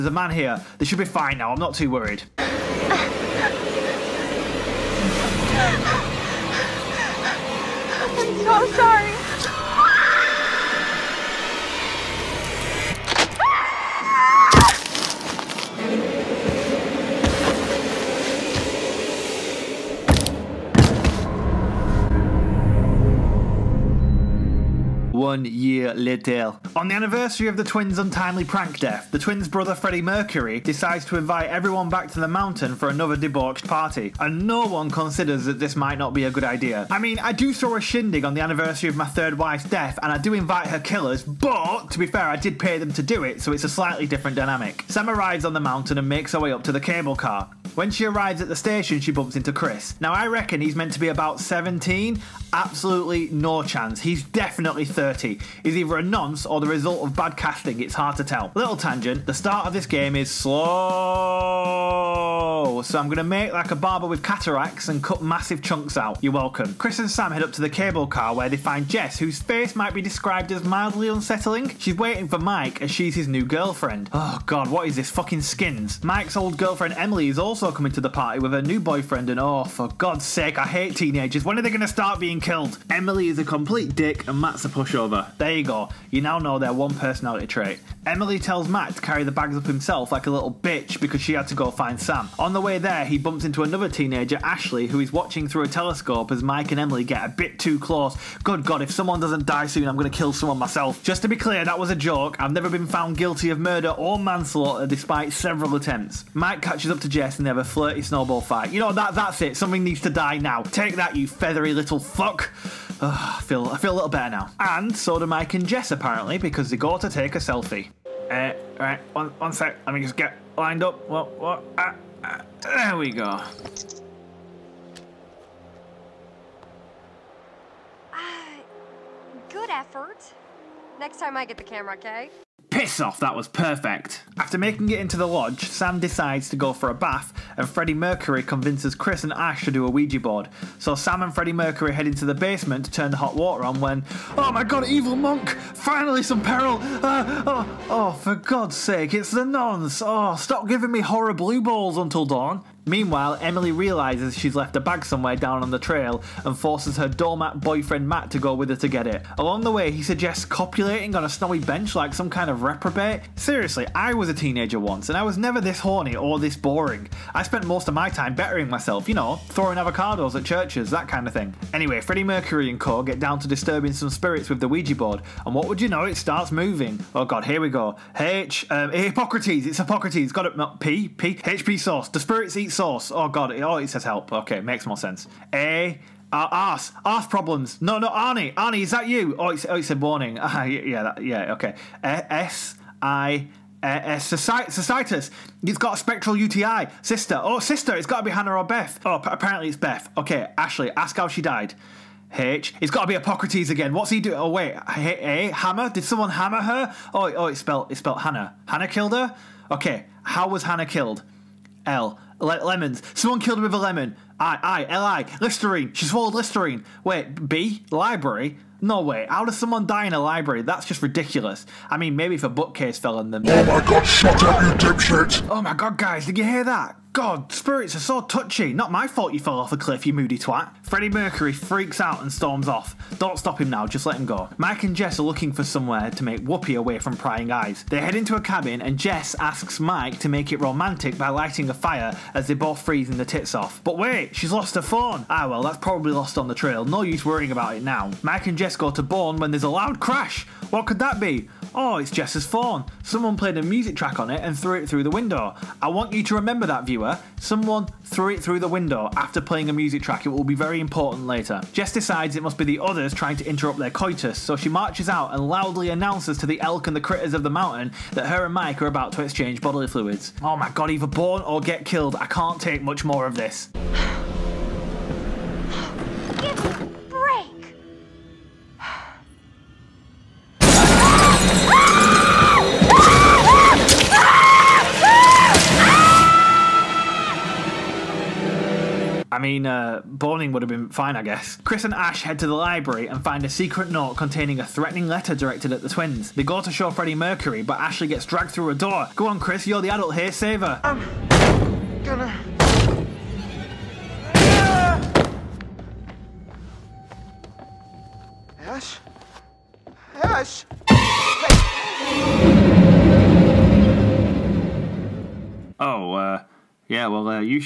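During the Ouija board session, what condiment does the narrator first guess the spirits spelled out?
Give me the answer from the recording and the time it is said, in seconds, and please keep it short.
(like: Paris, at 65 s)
HP sauce, at 181 s.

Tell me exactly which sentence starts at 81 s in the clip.
When are they gonna start being killed?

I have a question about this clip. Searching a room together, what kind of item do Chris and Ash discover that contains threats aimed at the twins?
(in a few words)
secret note.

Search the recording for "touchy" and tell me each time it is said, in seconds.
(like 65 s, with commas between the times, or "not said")
228 s.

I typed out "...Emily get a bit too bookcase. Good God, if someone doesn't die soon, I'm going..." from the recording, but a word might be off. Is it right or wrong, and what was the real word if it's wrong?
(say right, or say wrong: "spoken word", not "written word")
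wrong: "close", not "bookcase".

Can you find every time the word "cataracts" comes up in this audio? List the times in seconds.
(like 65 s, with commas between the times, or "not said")
64 s.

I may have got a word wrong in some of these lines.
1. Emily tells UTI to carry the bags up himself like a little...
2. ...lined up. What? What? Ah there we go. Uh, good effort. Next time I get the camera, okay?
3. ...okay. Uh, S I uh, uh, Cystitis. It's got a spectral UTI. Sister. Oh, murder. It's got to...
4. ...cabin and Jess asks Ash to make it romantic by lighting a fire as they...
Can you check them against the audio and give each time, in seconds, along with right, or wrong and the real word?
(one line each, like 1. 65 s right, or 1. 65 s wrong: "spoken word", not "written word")
1. 88 s wrong: "Matt", not "UTI"
2. 120 s right
3. 191 s wrong: "sister", not "murder"
4. 238 s wrong: "Mike", not "Ash".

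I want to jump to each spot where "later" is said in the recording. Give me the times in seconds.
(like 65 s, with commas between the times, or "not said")
25 s, 261 s.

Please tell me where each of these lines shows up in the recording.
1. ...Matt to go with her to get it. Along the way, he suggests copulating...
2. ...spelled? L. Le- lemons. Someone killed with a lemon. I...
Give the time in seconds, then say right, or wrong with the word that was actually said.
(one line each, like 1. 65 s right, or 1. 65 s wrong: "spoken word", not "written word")
1. 158 s right
2. 210 s wrong: "killed", not "spelled".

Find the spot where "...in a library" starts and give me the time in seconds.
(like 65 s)
220 s.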